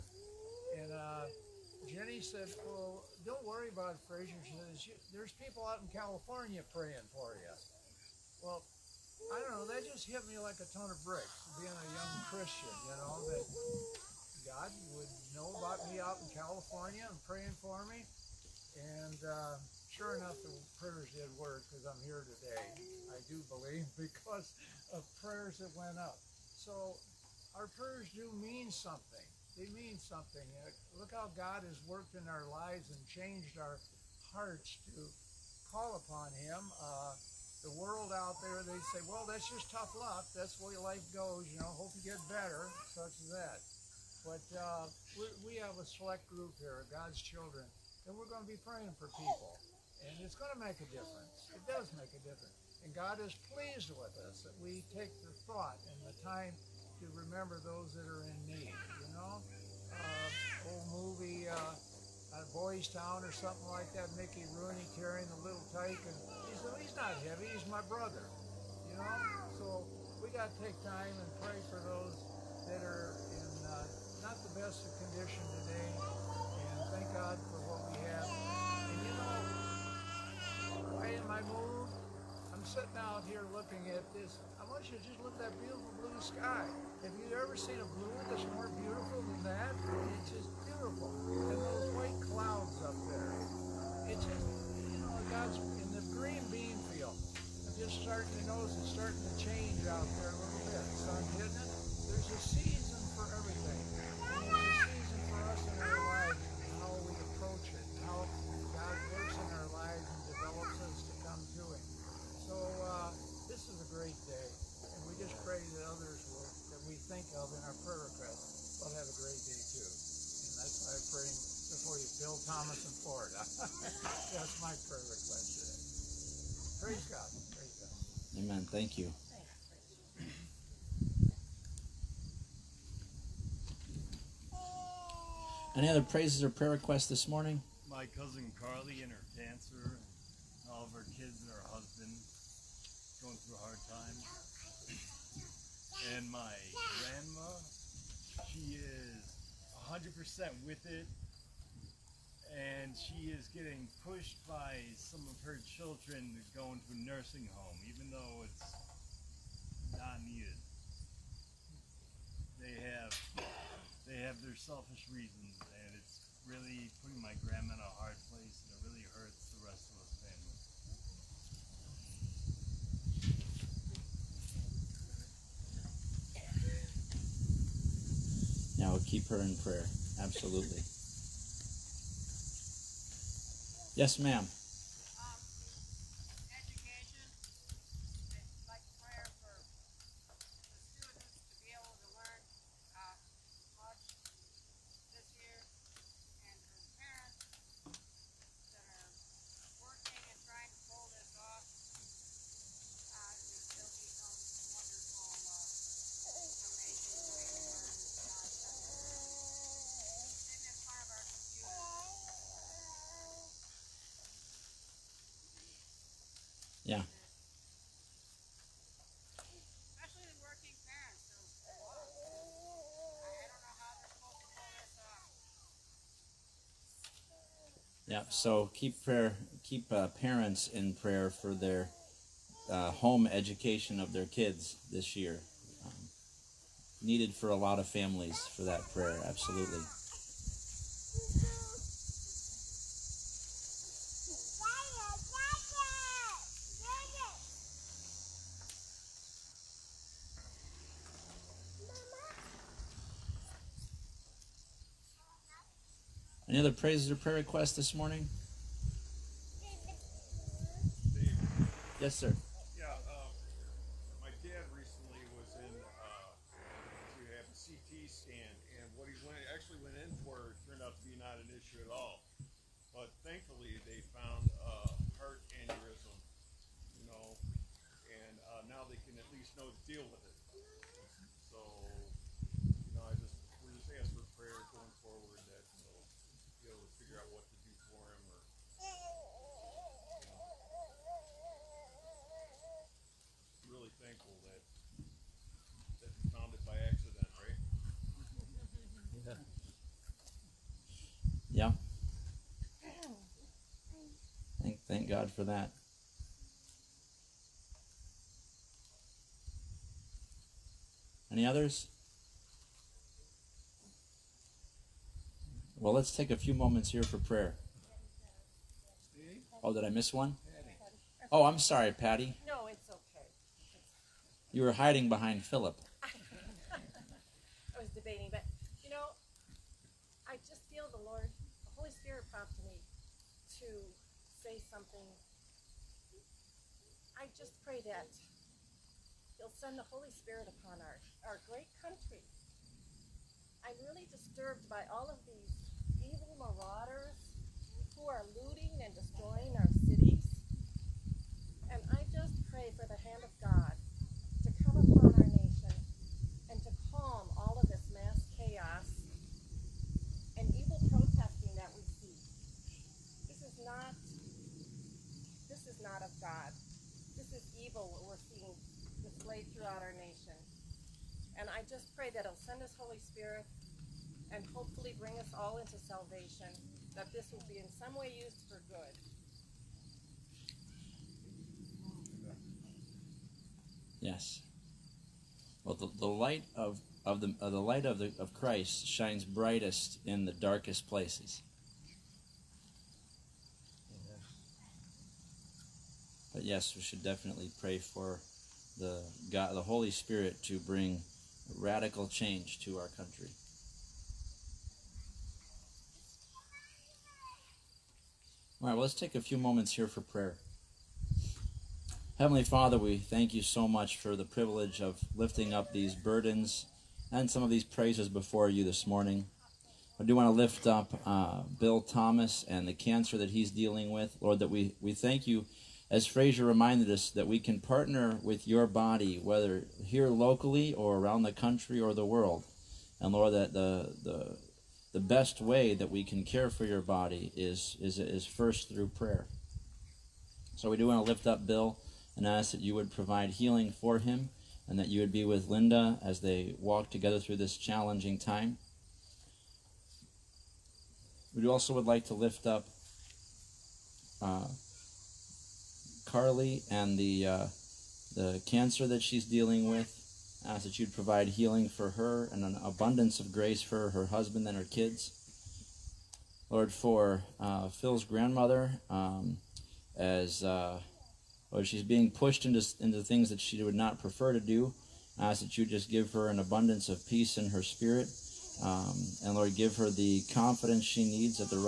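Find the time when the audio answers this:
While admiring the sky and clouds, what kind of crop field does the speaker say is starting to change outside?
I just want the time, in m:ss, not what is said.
1:36.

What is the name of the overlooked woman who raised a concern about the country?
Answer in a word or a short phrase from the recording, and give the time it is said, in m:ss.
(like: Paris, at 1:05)
Patty, at 5:21.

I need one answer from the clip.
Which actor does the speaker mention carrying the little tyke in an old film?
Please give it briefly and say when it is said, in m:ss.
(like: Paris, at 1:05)
Mickey Rooney, at 1:04.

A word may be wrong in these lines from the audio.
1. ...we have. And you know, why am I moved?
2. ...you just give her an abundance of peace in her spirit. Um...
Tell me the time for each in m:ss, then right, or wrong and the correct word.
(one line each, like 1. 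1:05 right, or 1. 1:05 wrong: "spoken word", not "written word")
1. 1:17 right
2. 7:55 right.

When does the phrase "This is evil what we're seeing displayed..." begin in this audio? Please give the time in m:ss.
6:07.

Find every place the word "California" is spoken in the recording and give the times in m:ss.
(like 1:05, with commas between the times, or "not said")
0:05, 0:16.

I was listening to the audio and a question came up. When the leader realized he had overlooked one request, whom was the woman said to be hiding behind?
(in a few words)
Philip.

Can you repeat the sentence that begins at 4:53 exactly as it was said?
really thankful that that you found it by accident, right?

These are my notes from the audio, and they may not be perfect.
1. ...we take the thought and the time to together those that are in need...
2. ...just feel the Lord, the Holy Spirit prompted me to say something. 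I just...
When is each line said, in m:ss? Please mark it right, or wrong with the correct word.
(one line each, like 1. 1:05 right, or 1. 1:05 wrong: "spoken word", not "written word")
1. 0:54 wrong: "remember", not "together"
2. 5:30 right.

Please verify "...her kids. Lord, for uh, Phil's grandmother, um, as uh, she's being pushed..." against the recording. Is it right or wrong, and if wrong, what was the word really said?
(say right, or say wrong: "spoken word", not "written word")
right.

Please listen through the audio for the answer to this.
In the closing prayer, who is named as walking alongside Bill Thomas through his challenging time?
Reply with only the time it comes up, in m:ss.
7:25.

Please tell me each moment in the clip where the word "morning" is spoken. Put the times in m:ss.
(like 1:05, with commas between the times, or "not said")
2:17, 4:17, 6:58.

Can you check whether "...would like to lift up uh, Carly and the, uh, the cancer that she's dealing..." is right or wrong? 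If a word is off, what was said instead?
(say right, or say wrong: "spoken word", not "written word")
right.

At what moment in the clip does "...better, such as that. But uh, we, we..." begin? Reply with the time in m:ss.
0:42.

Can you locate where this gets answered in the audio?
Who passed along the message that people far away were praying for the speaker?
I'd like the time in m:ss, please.
0:01.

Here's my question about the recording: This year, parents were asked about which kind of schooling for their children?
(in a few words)
home education.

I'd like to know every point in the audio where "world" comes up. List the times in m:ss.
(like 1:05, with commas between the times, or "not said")
0:37, 7:12.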